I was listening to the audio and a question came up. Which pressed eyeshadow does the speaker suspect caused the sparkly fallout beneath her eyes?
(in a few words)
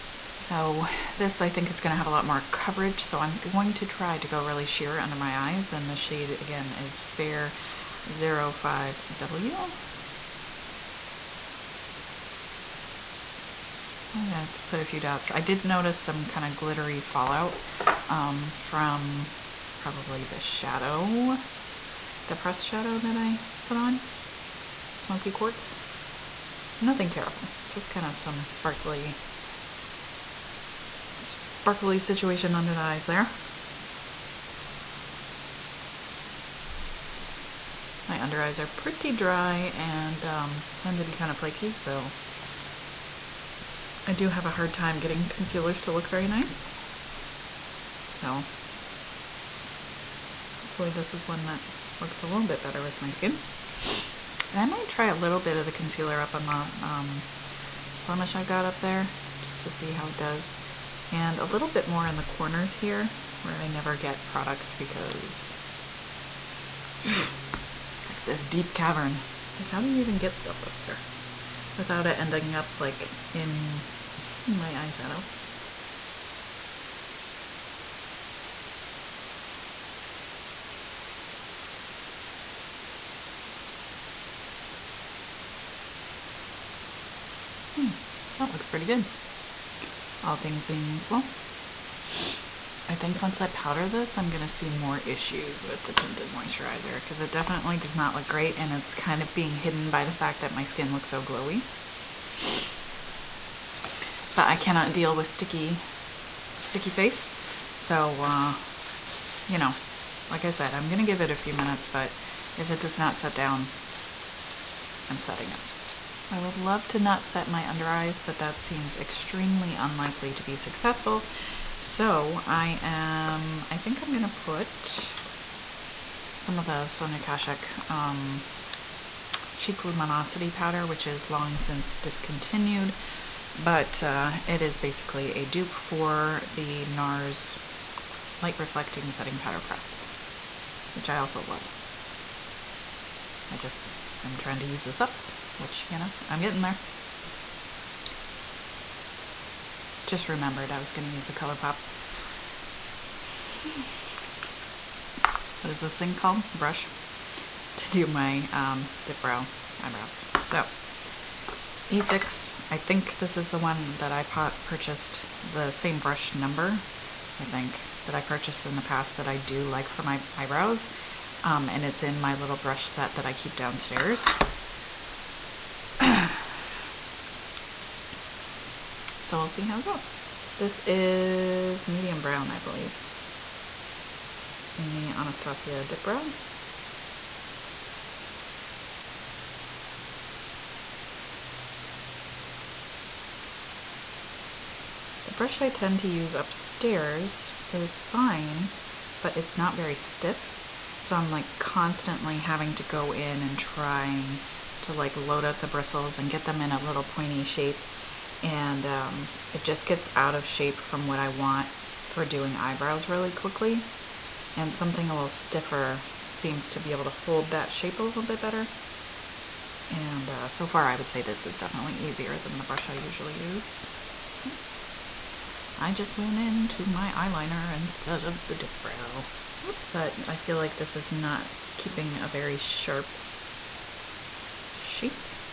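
Smoky Quartz.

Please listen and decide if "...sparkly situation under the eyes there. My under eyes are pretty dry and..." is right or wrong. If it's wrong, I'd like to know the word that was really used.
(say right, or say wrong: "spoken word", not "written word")
right.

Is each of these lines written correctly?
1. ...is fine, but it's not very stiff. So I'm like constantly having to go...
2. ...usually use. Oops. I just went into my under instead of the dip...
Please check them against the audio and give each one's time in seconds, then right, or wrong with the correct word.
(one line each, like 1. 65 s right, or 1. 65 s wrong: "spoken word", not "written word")
1. 197 s right
2. 222 s wrong: "eyeliner", not "under".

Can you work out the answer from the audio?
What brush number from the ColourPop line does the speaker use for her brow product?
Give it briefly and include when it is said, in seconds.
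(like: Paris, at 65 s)
E6, at 161 s.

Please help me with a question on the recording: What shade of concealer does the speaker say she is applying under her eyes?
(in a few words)
Fair 05W.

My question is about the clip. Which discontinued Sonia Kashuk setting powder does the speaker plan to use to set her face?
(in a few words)
Chic Luminosity.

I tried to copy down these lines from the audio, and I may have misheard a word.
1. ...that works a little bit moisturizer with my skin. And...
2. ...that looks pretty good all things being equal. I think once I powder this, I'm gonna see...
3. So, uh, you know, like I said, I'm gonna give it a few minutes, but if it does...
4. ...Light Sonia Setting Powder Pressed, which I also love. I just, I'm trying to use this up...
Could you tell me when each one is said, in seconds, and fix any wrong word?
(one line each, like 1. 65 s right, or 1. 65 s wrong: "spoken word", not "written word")
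1. 51 s wrong: "better", not "moisturizer"
2. 88 s right
3. 107 s right
4. 138 s wrong: "Reflecting", not "Sonia".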